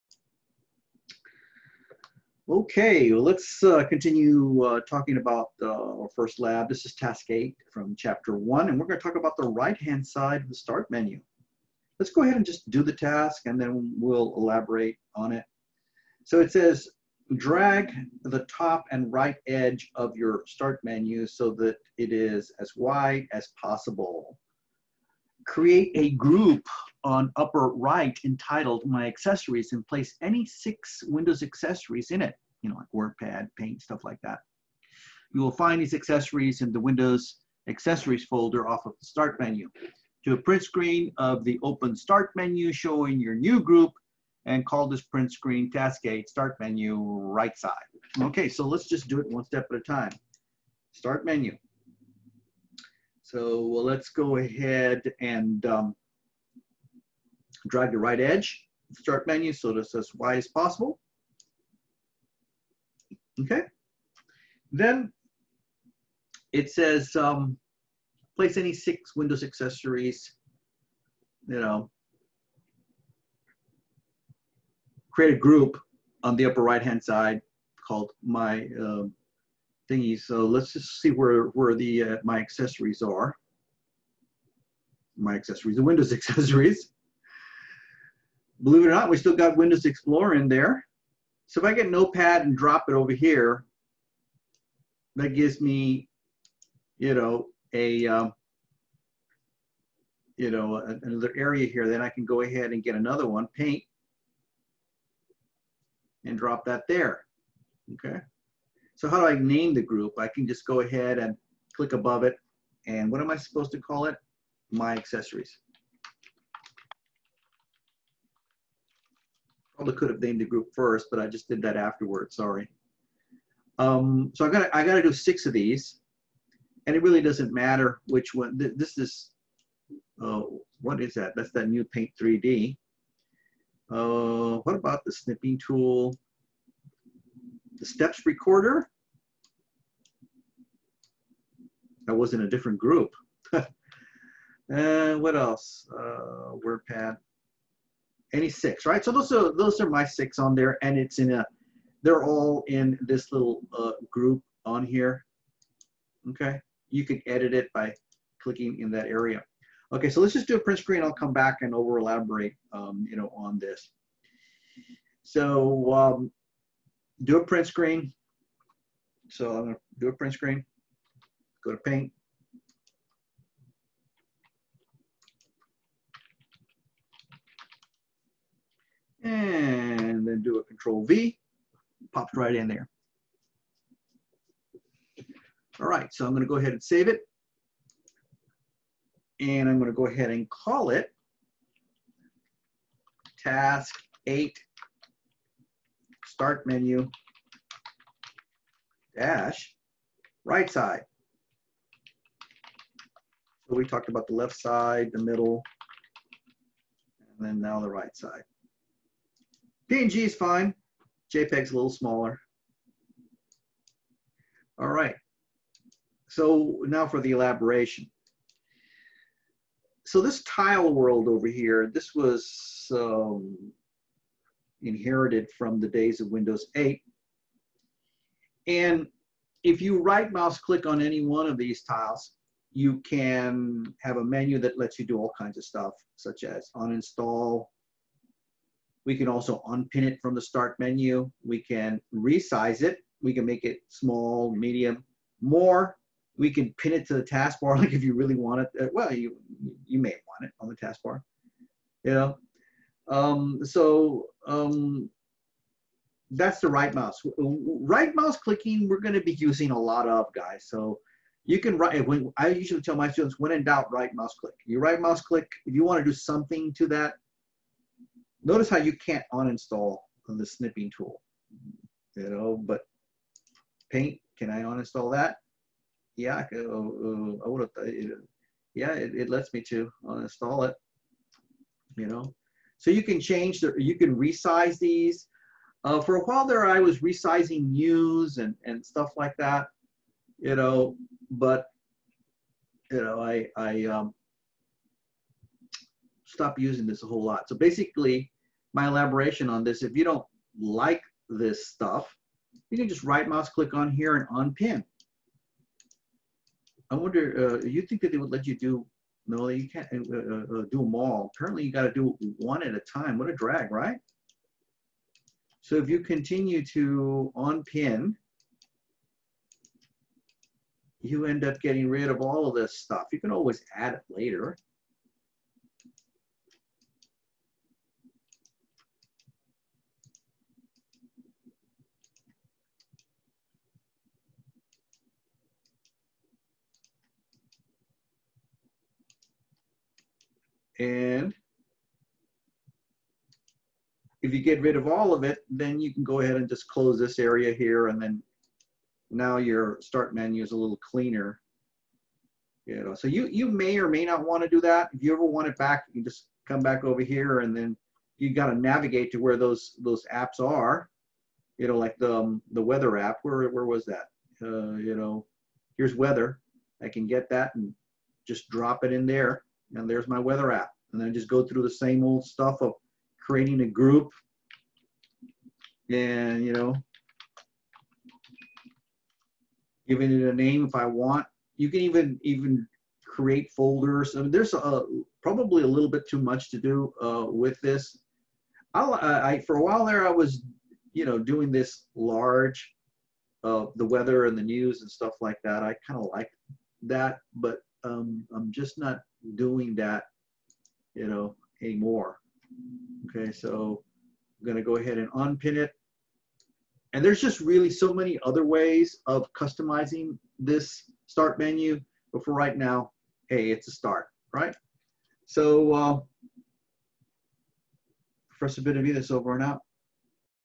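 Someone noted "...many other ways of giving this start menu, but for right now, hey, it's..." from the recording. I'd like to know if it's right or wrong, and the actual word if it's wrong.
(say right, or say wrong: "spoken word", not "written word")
wrong: "customizing", not "giving".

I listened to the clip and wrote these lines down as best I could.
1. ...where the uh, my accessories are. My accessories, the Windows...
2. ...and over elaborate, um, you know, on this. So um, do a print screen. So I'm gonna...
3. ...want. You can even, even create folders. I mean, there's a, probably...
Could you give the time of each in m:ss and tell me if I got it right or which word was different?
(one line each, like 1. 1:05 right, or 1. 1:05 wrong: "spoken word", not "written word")
1. 1:21 right
2. 2:41 right
3. 6:20 right.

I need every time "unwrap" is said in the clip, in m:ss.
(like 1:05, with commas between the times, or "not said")
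not said.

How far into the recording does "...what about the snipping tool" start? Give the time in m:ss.
2:14.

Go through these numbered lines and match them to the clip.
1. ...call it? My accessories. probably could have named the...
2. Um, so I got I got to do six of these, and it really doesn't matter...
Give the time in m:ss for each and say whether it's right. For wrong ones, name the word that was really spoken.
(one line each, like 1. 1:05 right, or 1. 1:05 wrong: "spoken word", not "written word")
1. 1:53 right
2. 2:03 right.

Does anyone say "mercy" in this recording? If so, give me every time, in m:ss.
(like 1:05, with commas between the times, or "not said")
not said.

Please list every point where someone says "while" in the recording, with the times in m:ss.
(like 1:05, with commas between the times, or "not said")
4:46, 6:29.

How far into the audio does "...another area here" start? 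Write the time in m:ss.
1:41.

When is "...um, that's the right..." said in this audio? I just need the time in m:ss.
4:14.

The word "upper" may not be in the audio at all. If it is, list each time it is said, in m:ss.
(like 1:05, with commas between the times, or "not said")
0:27, 1:16.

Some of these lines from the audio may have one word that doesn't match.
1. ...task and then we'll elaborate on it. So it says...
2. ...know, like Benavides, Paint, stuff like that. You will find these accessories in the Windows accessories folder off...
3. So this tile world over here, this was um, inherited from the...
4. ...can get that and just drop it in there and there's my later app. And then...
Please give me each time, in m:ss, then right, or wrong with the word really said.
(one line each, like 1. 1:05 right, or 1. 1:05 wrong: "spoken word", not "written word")
1. 0:12 right
2. 0:32 wrong: "WordPad", not "Benavides"
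3. 3:40 right
4. 6:06 wrong: "weather", not "later".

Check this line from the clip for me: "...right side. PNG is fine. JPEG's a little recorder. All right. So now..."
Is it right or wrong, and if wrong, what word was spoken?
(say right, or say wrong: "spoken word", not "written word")
wrong: "smaller", not "recorder".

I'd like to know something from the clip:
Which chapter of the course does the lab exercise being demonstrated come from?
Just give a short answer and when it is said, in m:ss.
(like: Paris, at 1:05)
Chapter 1, at 0:07.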